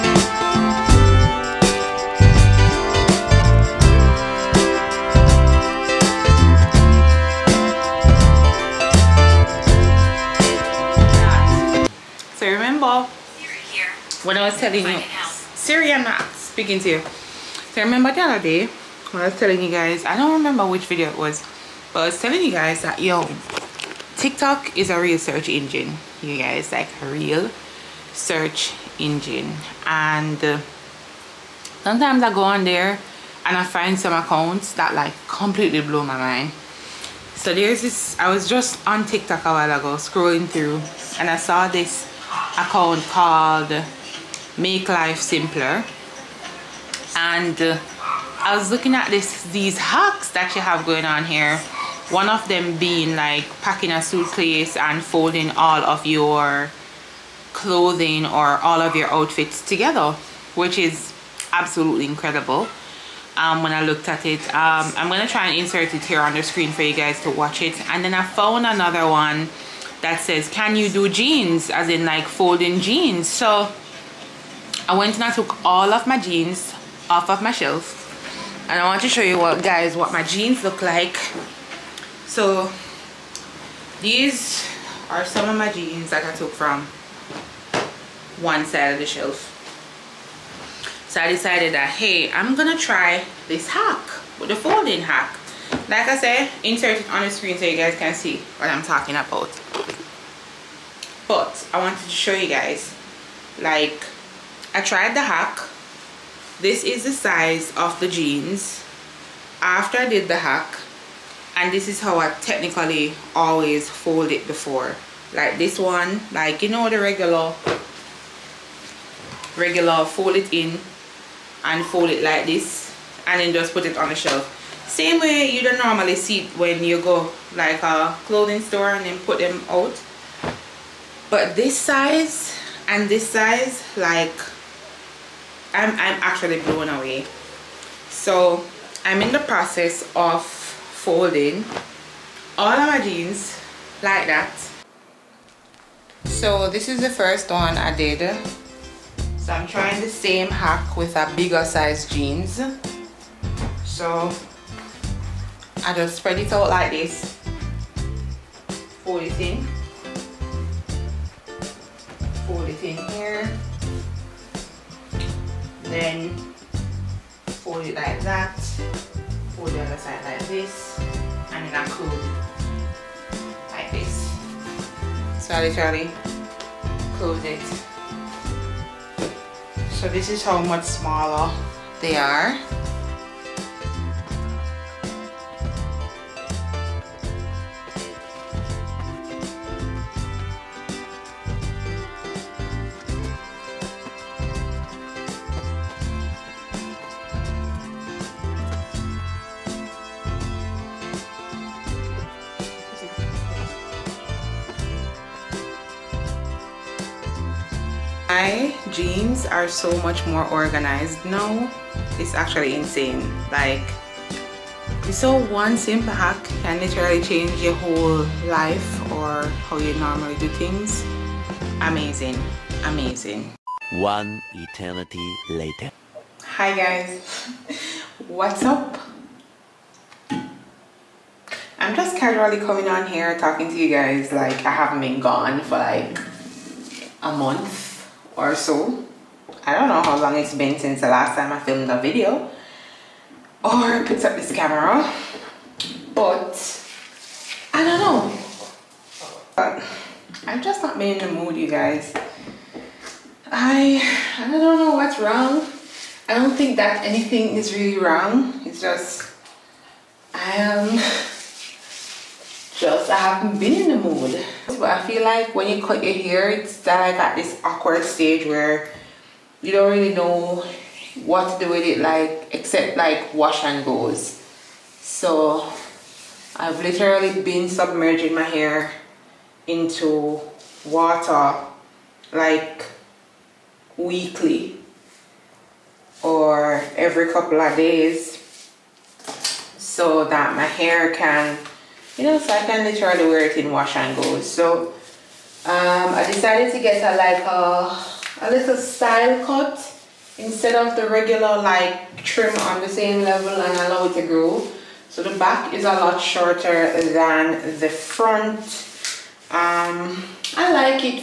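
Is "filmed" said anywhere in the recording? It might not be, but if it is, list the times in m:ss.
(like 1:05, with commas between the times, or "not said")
4:01.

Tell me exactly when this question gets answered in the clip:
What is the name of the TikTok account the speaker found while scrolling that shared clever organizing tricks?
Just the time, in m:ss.
0:44.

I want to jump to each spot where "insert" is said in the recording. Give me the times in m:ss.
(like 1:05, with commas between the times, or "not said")
1:05, 1:36.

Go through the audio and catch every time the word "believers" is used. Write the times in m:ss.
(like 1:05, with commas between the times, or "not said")
not said.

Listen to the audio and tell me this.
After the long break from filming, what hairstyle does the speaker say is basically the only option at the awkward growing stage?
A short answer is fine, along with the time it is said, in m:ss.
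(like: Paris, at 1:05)
wash and go, at 4:33.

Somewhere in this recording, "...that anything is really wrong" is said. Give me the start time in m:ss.
4:16.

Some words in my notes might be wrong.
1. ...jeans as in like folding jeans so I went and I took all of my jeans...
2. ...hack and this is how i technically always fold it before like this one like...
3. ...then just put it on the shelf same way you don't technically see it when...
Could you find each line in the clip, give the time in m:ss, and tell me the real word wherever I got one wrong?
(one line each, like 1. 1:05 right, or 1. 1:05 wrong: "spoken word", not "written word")
1. 1:11 right
2. 1:50 right
3. 2:03 wrong: "normally", not "technically".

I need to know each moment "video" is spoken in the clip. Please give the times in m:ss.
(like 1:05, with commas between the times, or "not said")
0:20, 4:02.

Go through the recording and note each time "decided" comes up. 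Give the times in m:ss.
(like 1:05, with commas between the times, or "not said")
1:31, 4:56.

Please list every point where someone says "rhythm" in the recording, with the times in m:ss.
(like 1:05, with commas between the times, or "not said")
not said.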